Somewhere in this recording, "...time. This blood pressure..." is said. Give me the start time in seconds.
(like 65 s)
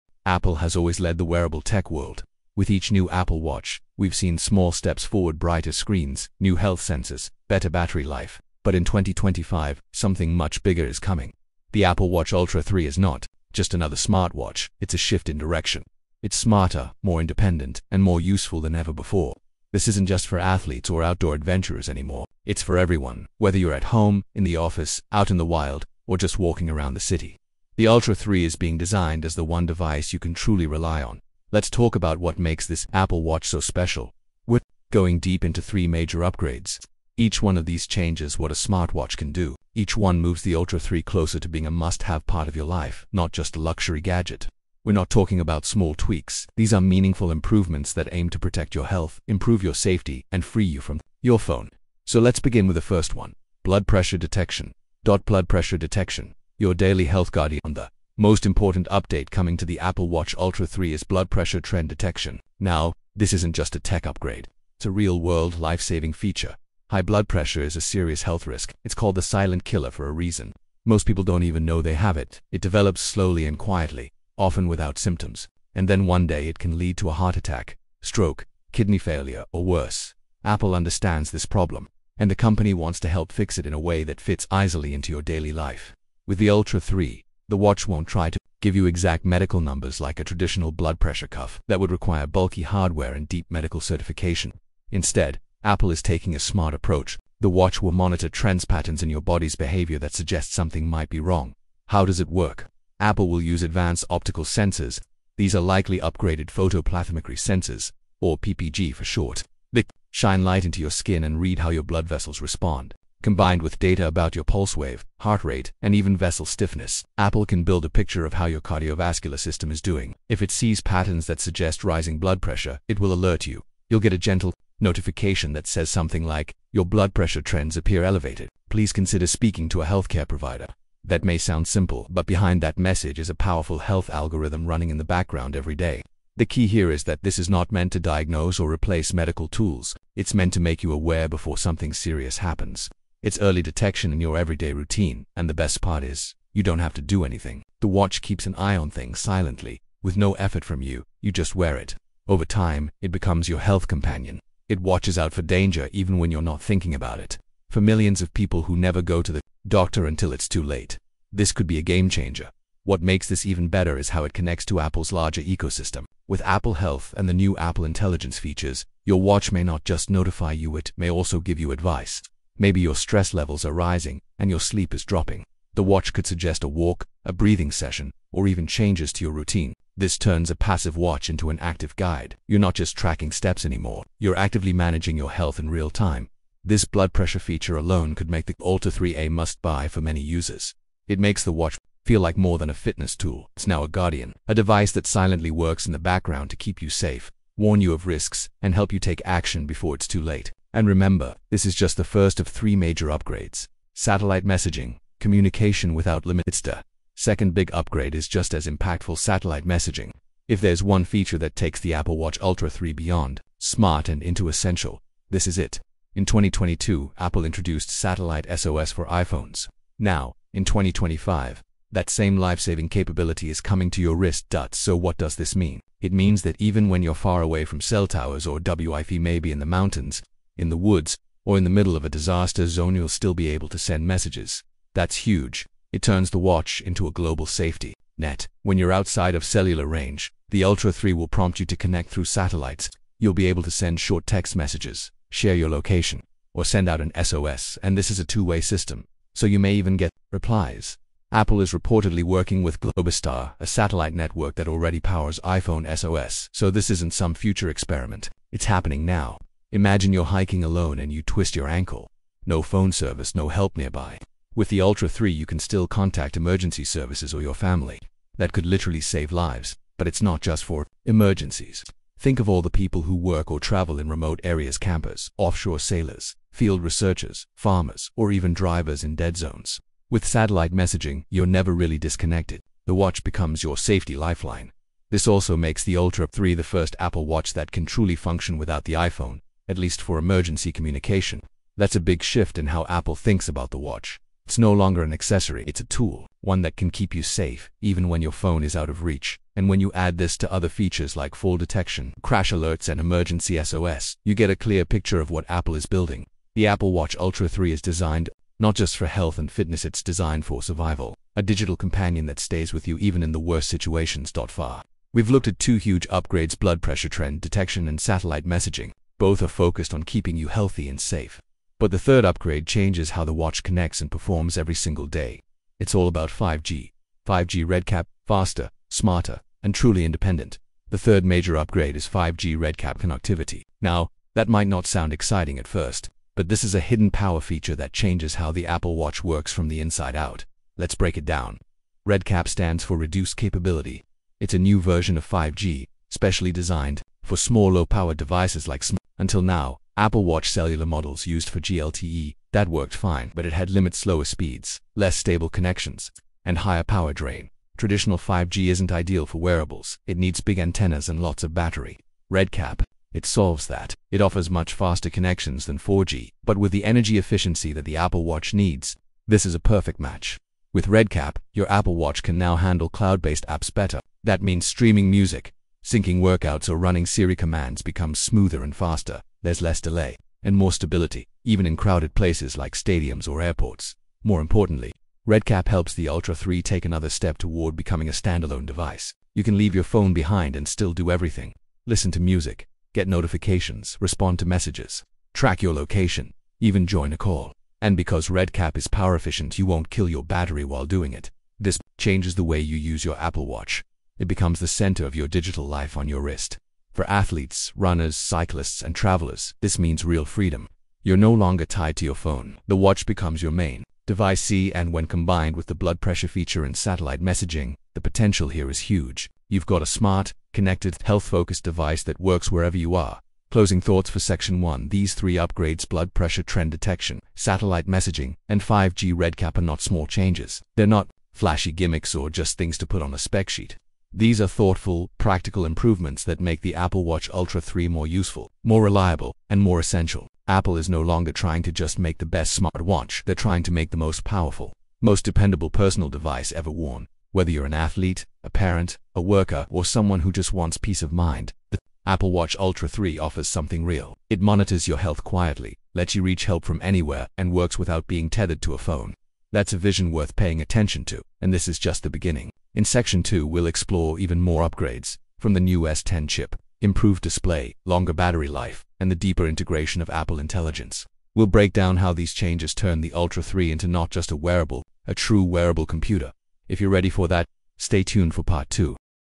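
185 s.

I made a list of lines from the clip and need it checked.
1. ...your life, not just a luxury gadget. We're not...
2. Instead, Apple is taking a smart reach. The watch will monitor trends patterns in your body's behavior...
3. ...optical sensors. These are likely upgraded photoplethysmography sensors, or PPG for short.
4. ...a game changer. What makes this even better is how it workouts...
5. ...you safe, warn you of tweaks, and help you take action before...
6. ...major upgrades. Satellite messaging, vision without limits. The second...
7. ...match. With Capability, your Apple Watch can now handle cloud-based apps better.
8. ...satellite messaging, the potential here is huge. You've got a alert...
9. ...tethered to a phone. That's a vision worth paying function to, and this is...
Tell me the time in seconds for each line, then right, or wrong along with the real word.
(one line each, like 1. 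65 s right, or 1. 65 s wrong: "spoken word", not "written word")
1. 42 s right
2. 94 s wrong: "approach", not "reach"
3. 104 s right
4. 161 s wrong: "connects", not "workouts"
5. 196 s wrong: "risks", not "tweaks"
6. 202 s wrong: "communication", not "vision"
7. 369 s wrong: "Redcap", not "Capability"
8. 416 s wrong: "smart", not "alert"
9. 458 s wrong: "attention", not "function".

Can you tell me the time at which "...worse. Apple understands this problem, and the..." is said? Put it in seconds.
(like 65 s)
79 s.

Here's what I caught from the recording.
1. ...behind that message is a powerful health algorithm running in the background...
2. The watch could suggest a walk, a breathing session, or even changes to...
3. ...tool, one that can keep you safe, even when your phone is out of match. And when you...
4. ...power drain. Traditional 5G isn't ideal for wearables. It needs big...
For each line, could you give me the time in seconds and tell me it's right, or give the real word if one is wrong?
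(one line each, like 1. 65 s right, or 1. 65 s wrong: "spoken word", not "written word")
1. 132 s right
2. 175 s right
3. 295 s wrong: "reach", not "match"
4. 356 s right.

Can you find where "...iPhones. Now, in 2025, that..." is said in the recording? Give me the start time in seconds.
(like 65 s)
219 s.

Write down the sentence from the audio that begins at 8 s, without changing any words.
But in 2025, something much bigger is coming.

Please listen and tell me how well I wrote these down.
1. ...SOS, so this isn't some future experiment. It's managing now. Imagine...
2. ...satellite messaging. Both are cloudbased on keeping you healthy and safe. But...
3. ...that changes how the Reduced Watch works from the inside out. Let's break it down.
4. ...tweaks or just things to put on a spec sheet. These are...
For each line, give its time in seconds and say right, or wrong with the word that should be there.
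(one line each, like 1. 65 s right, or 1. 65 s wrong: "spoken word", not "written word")
1. 255 s wrong: "happening", not "managing"
2. 318 s wrong: "focused", not "cloudbased"
3. 337 s wrong: "Apple", not "Reduced"
4. 431 s wrong: "gimmicks", not "tweaks".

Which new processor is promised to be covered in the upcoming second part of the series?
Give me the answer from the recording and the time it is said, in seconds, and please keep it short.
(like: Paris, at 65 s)
S10 chip, at 465 s.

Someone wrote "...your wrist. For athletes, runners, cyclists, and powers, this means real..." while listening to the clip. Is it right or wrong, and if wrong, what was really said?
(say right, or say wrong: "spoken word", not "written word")
wrong: "travelers", not "powers".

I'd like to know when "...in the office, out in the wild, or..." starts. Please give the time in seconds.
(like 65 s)
24 s.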